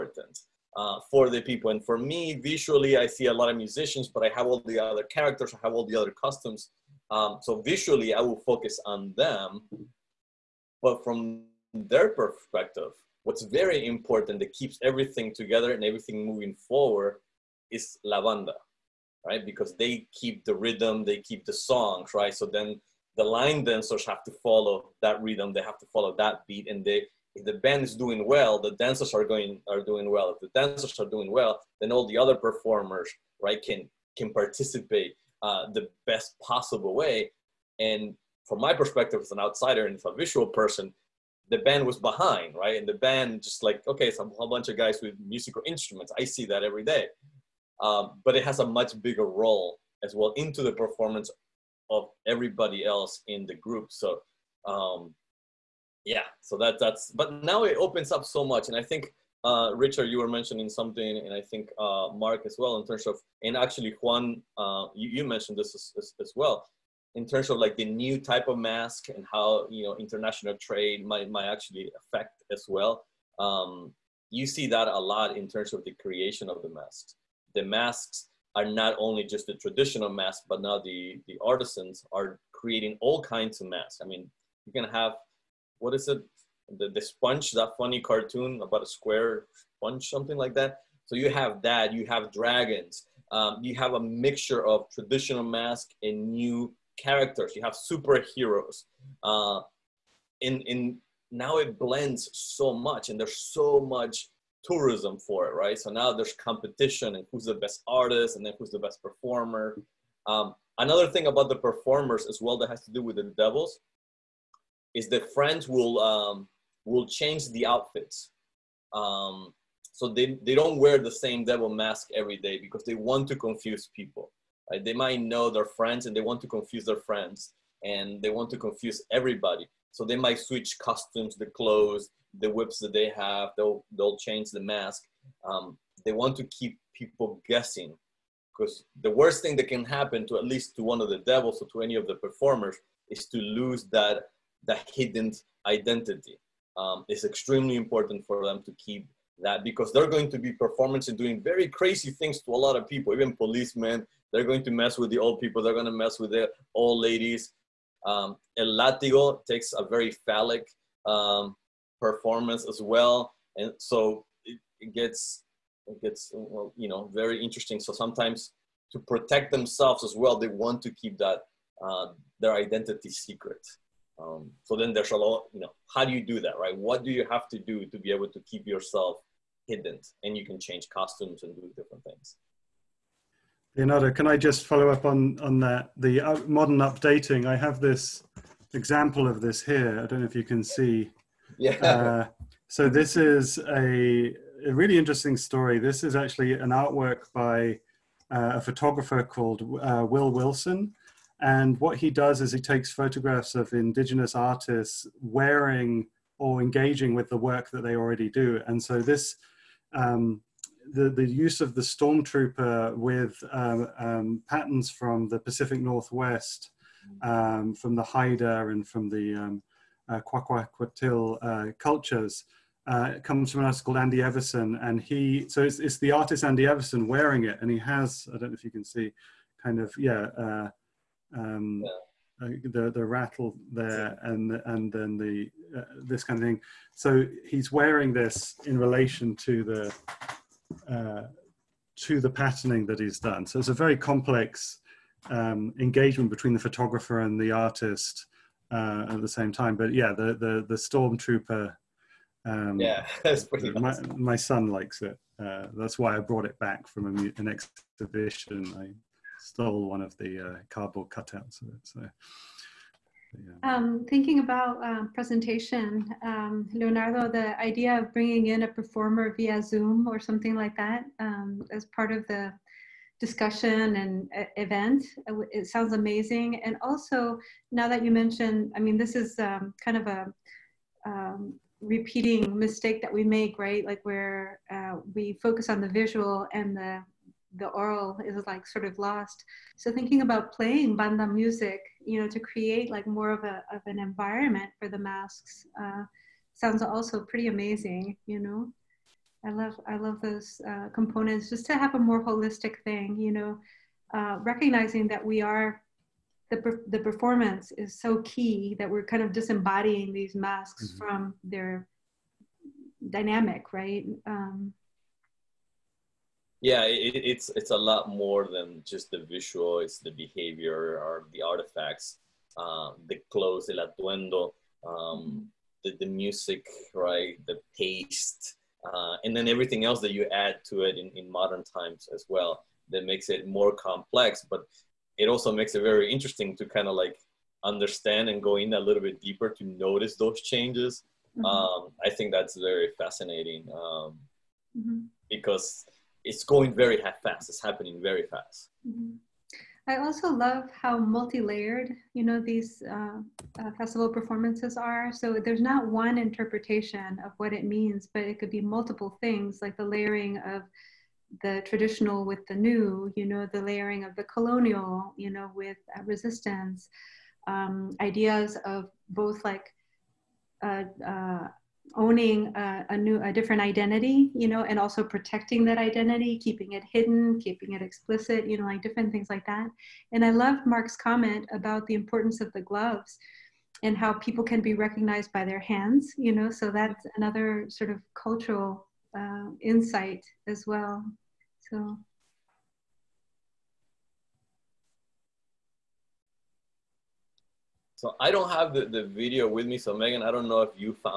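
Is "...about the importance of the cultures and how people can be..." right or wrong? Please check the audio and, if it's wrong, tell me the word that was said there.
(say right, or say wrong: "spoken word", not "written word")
wrong: "gloves", not "cultures".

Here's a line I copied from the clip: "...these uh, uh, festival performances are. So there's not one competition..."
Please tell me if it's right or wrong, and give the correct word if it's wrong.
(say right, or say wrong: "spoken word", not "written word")
wrong: "interpretation", not "competition".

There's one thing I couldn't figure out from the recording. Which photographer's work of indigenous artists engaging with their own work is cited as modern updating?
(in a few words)
Will Wilson.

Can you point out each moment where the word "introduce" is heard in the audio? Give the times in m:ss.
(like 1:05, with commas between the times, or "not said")
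not said.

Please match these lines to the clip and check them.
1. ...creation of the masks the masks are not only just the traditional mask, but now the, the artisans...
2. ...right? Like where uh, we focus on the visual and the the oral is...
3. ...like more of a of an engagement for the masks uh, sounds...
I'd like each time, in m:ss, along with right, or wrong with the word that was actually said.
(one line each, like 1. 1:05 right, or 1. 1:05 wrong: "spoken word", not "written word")
1. 1:16 right
2. 4:43 right
3. 4:52 wrong: "environment", not "engagement".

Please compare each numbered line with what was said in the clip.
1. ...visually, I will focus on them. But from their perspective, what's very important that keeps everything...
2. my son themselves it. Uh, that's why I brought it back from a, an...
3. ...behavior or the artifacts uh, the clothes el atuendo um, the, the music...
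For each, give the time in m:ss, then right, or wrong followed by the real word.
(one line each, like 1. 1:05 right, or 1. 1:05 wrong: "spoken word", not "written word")
1. 0:07 right
2. 4:14 wrong: "likes", not "themselves"
3. 5:20 right.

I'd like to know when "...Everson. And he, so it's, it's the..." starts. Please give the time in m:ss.
3:44.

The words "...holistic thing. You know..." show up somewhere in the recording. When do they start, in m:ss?
5:02.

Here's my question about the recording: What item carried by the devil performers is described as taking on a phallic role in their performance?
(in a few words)
El Látigo.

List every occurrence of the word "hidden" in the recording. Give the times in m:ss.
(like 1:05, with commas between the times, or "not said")
2:24, 2:59, 6:16.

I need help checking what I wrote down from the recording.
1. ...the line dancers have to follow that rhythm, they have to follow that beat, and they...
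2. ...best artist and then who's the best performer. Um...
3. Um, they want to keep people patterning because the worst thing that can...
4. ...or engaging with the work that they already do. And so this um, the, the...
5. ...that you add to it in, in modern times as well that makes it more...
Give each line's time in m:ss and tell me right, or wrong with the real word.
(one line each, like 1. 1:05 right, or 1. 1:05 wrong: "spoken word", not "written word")
1. 0:23 right
2. 1:47 right
3. 2:15 wrong: "guessing", not "patterning"
4. 3:26 right
5. 5:30 right.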